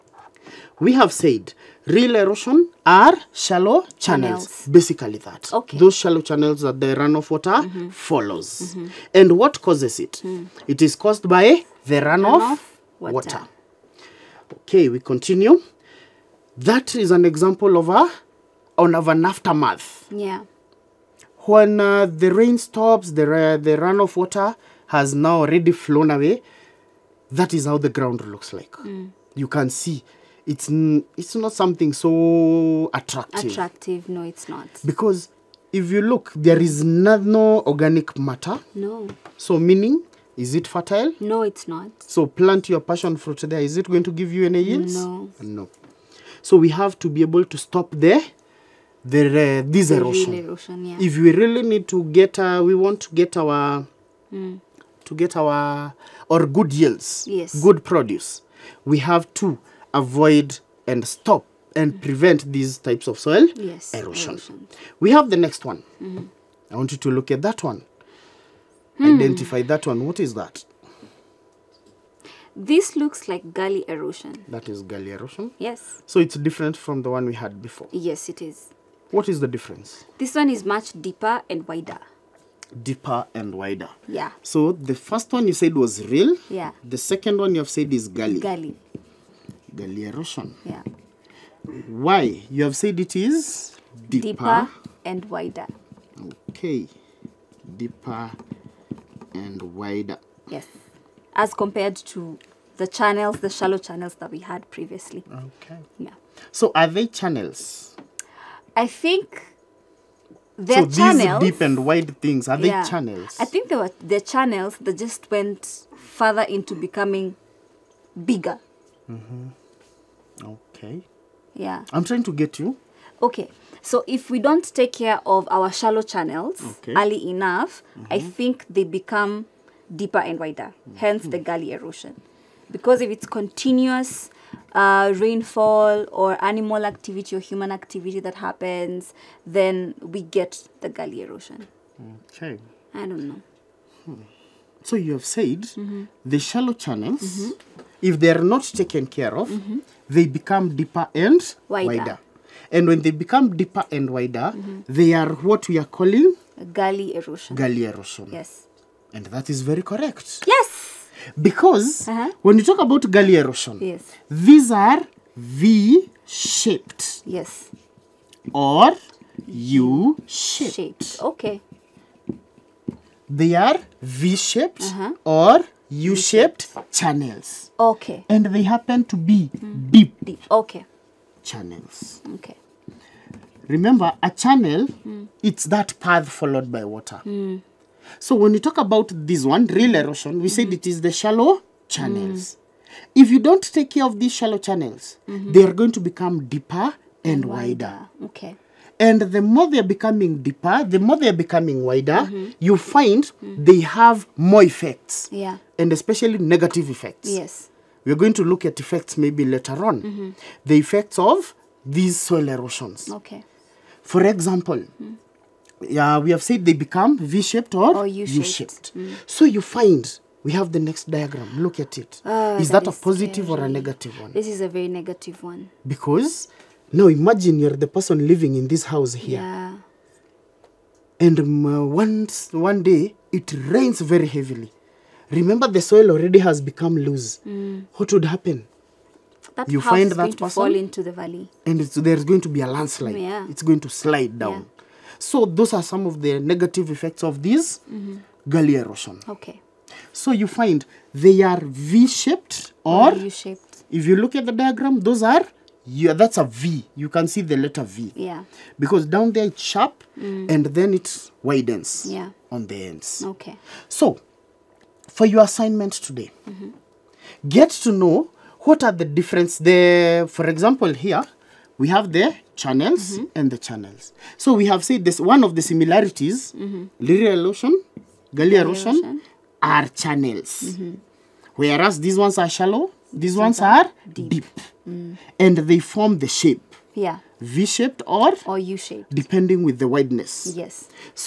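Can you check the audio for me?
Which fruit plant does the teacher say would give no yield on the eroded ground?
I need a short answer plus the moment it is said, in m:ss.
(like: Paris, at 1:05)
passion fruit, at 0:42.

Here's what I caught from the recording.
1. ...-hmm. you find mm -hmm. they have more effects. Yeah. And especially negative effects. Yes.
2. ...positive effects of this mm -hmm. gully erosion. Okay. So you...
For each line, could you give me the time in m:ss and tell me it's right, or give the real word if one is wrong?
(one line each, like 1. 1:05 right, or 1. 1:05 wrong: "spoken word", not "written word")
1. 3:22 right
2. 4:06 wrong: "negative", not "positive".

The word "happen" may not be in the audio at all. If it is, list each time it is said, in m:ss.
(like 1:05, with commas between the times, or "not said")
2:18, 2:58, 3:58.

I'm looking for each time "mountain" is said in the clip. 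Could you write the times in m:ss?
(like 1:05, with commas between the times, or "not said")
not said.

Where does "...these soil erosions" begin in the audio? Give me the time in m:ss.
3:31.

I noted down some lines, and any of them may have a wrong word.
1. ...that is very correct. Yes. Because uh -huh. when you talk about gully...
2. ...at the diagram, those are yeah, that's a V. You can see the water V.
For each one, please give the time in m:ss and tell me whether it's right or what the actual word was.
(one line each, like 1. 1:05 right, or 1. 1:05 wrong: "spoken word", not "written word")
1. 2:39 right
2. 4:14 wrong: "letter", not "water".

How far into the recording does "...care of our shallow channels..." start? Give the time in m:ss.
2:04.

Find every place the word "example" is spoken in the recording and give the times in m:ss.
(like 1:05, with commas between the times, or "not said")
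0:17, 3:34, 4:30.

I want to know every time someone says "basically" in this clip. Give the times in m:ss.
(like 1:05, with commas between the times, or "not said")
0:04.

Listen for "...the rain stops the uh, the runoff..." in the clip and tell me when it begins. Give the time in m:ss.
0:22.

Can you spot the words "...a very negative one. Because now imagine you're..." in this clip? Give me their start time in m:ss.
3:44.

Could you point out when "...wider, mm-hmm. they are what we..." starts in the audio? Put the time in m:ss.
2:34.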